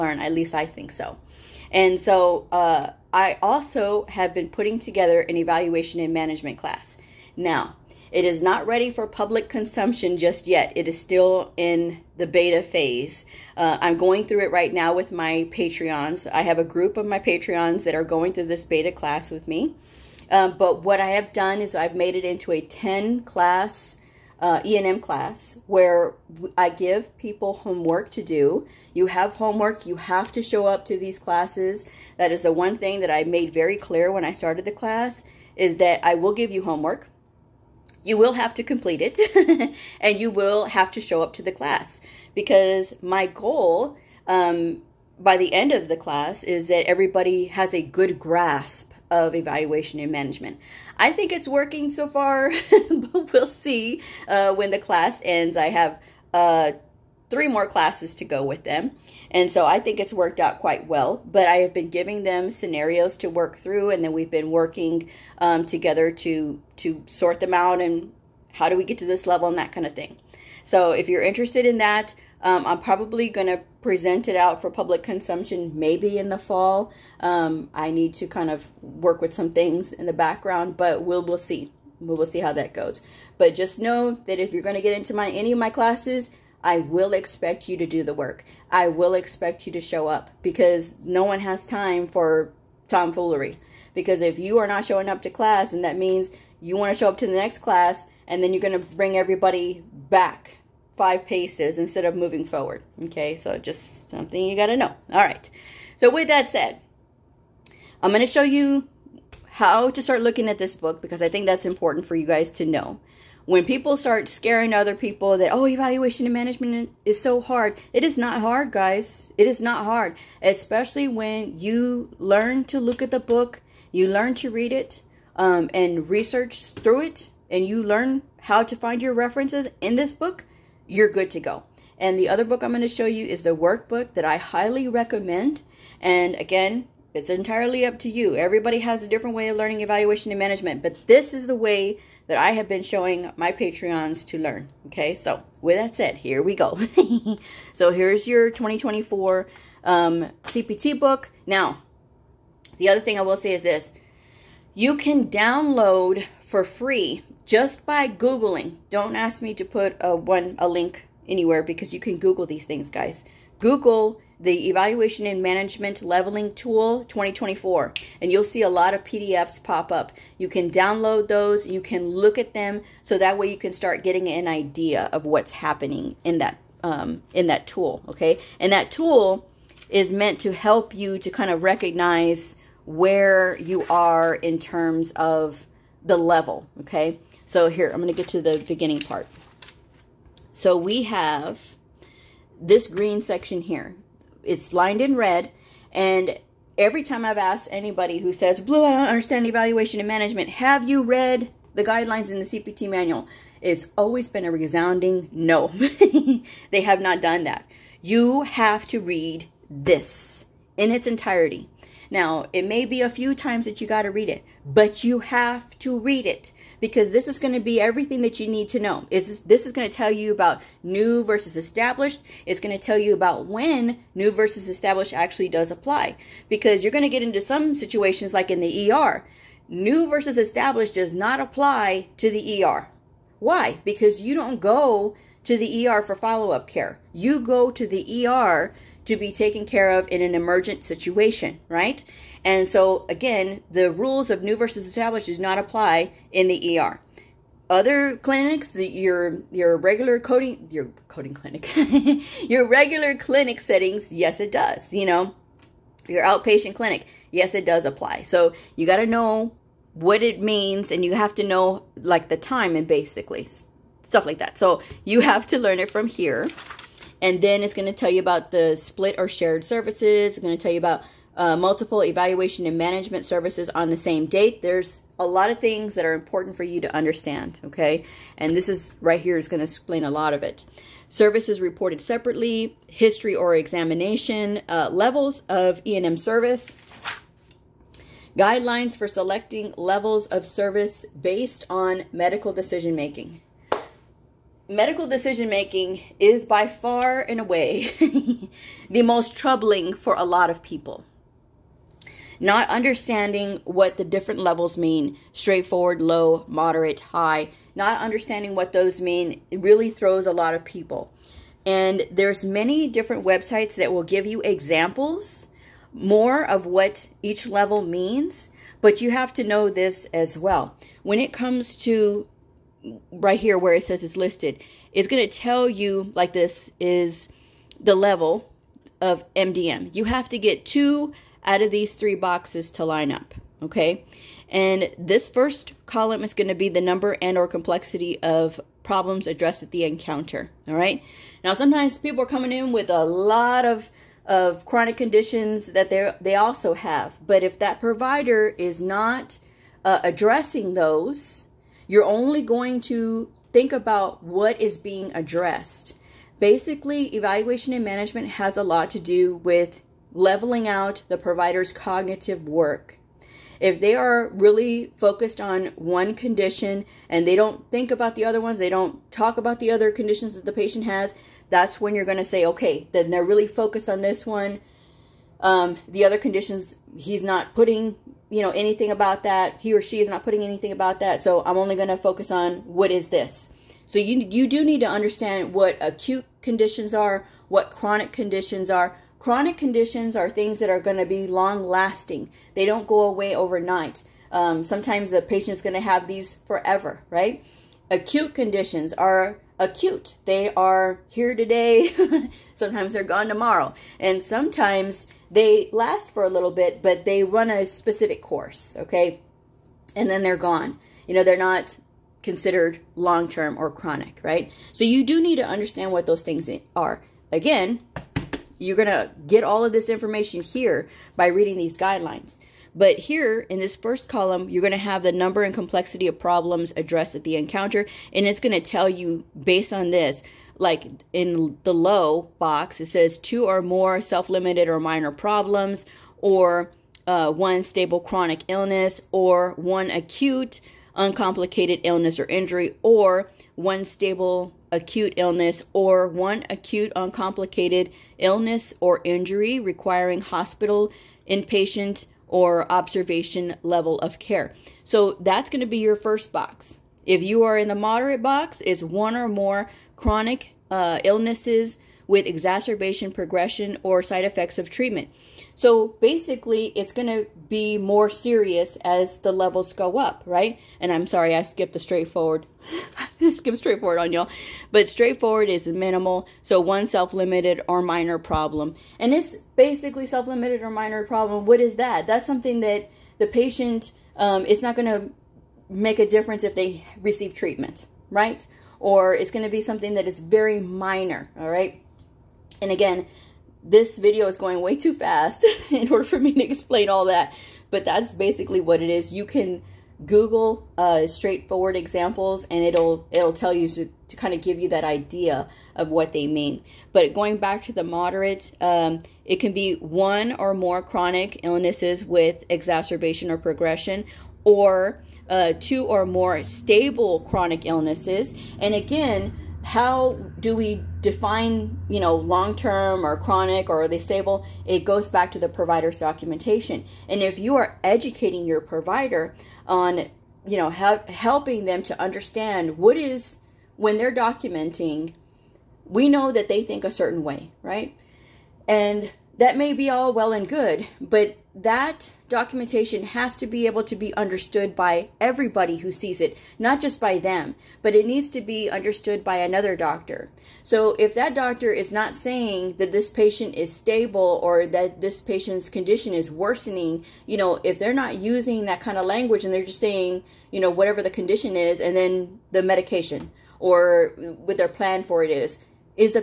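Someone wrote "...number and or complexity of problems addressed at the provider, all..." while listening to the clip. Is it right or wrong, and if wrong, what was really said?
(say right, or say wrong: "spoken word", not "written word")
wrong: "encounter", not "provider".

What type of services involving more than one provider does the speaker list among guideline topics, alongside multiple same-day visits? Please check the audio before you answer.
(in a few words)
split or shared services.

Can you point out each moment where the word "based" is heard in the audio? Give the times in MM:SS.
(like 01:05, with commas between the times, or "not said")
04:51, 07:09.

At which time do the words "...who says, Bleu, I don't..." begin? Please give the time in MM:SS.
03:18.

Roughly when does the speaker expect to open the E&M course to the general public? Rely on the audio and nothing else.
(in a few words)
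the fall.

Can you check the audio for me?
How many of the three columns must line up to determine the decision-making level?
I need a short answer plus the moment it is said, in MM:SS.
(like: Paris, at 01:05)
2, at 05:30.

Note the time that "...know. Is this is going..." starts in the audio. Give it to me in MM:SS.
03:38.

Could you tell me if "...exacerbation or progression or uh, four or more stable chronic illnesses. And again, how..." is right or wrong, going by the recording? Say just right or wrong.
wrong.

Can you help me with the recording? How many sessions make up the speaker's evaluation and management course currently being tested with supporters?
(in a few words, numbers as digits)
10.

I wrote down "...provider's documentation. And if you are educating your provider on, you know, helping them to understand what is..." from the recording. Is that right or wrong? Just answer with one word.
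right.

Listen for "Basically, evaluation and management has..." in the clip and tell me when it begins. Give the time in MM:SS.
05:56.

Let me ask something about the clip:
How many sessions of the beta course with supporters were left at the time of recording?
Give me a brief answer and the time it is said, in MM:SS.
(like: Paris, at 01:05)
3, at 00:57.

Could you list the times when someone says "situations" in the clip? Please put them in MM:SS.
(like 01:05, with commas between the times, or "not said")
03:47, 04:00.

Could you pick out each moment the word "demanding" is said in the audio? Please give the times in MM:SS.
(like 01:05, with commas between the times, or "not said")
not said.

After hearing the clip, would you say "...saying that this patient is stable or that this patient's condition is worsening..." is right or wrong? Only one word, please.
right.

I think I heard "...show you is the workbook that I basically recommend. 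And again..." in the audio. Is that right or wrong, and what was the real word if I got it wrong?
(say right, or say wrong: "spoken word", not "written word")
wrong: "highly", not "basically".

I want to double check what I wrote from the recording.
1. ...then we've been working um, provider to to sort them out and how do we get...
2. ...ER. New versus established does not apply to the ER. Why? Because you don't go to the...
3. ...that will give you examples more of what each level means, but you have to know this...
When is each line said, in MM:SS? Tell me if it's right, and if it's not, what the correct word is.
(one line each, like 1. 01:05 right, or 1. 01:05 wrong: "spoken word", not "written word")
1. 01:04 wrong: "together", not "provider"
2. 03:48 right
3. 05:13 right.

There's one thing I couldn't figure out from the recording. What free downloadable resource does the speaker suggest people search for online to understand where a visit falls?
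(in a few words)
Evaluation and Management Leveling Tool.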